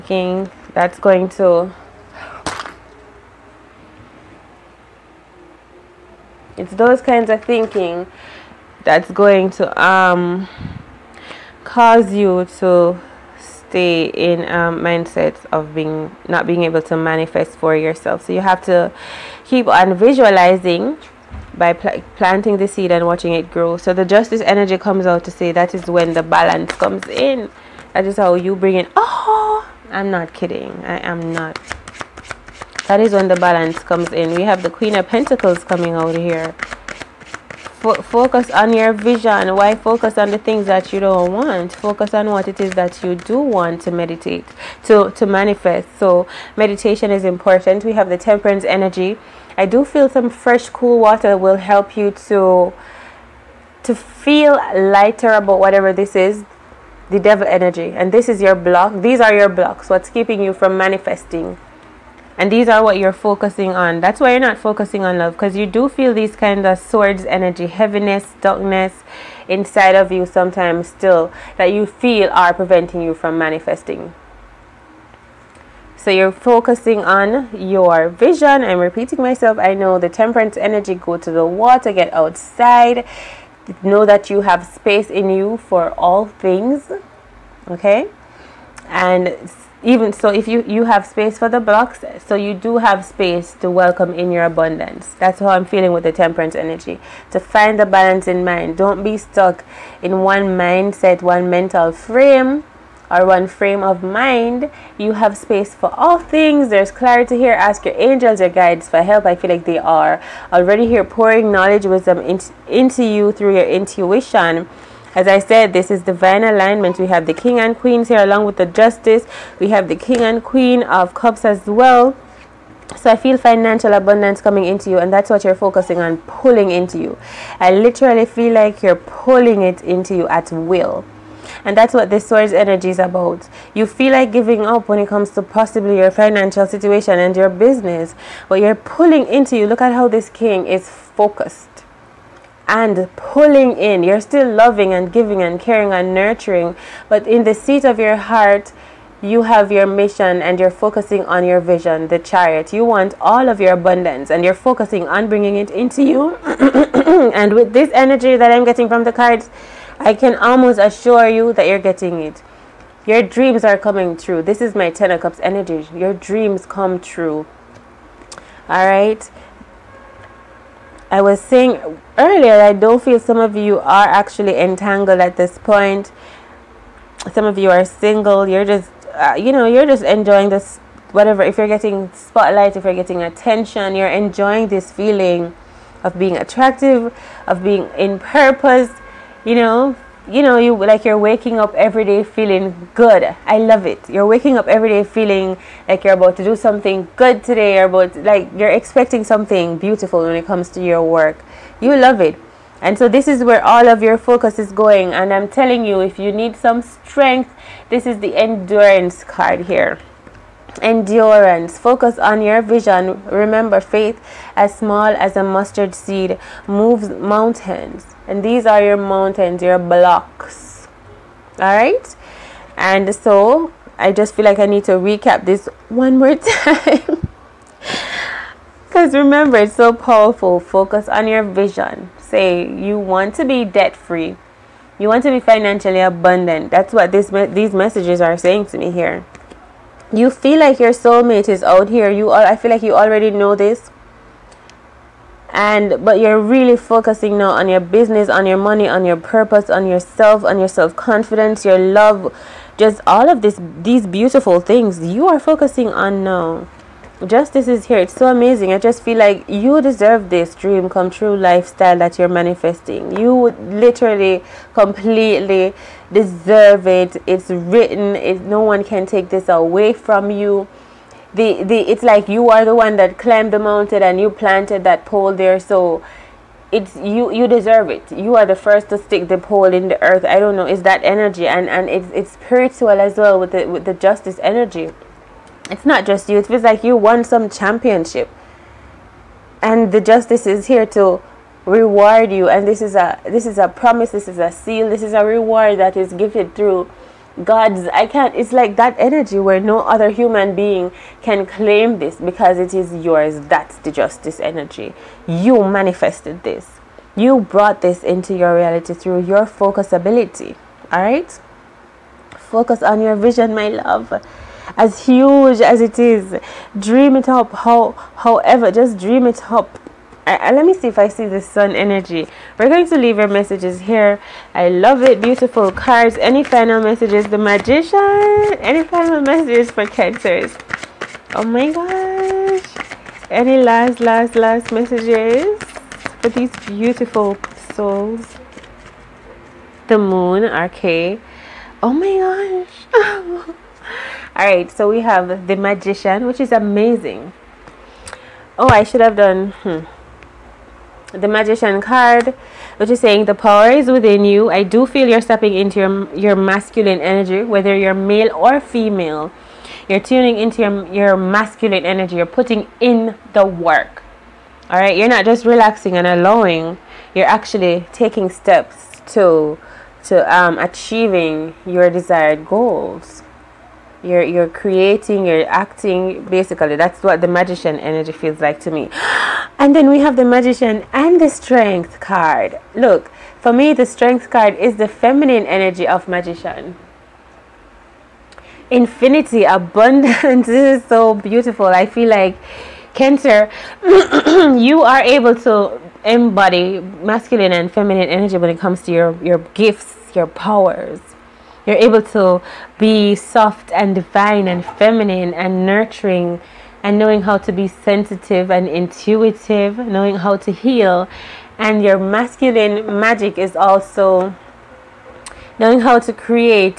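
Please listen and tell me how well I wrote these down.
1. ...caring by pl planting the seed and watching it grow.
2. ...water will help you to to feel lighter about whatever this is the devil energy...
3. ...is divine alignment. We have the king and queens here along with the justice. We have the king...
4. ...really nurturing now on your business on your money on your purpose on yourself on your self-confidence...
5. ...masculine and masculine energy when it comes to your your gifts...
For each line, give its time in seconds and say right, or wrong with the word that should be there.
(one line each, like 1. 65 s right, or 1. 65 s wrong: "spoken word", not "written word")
1. 19 s wrong: "visualizing", not "caring"
2. 50 s right
3. 115 s right
4. 246 s wrong: "focusing", not "nurturing"
5. 396 s wrong: "feminine", not "masculine".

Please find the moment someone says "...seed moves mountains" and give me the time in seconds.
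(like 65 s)
215 s.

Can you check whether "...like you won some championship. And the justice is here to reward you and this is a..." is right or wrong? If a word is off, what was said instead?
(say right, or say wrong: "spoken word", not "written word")
right.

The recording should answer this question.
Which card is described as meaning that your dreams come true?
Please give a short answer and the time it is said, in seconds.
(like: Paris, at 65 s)
Ten of Cups, at 164 s.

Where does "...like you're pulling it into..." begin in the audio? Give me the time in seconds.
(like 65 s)
128 s.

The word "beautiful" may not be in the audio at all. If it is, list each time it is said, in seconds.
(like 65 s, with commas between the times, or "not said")
199 s, 254 s, 325 s, 336 s, 391 s.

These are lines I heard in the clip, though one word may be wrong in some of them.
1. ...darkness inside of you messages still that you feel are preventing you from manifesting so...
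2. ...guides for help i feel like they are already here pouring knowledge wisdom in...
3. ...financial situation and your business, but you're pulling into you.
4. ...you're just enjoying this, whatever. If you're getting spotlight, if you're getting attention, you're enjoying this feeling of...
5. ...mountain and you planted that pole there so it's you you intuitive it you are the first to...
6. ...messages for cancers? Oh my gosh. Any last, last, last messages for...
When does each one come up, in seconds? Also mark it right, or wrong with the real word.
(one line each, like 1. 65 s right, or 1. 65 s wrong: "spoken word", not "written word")
1. 68 s wrong: "sometimes", not "messages"
2. 108 s right
3. 136 s right
4. 179 s right
5. 273 s wrong: "deserve", not "intuitive"
6. 329 s right.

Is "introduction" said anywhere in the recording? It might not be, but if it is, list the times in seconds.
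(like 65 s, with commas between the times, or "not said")
not said.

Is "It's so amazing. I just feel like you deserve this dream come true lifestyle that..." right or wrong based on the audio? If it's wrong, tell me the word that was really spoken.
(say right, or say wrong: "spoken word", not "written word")
right.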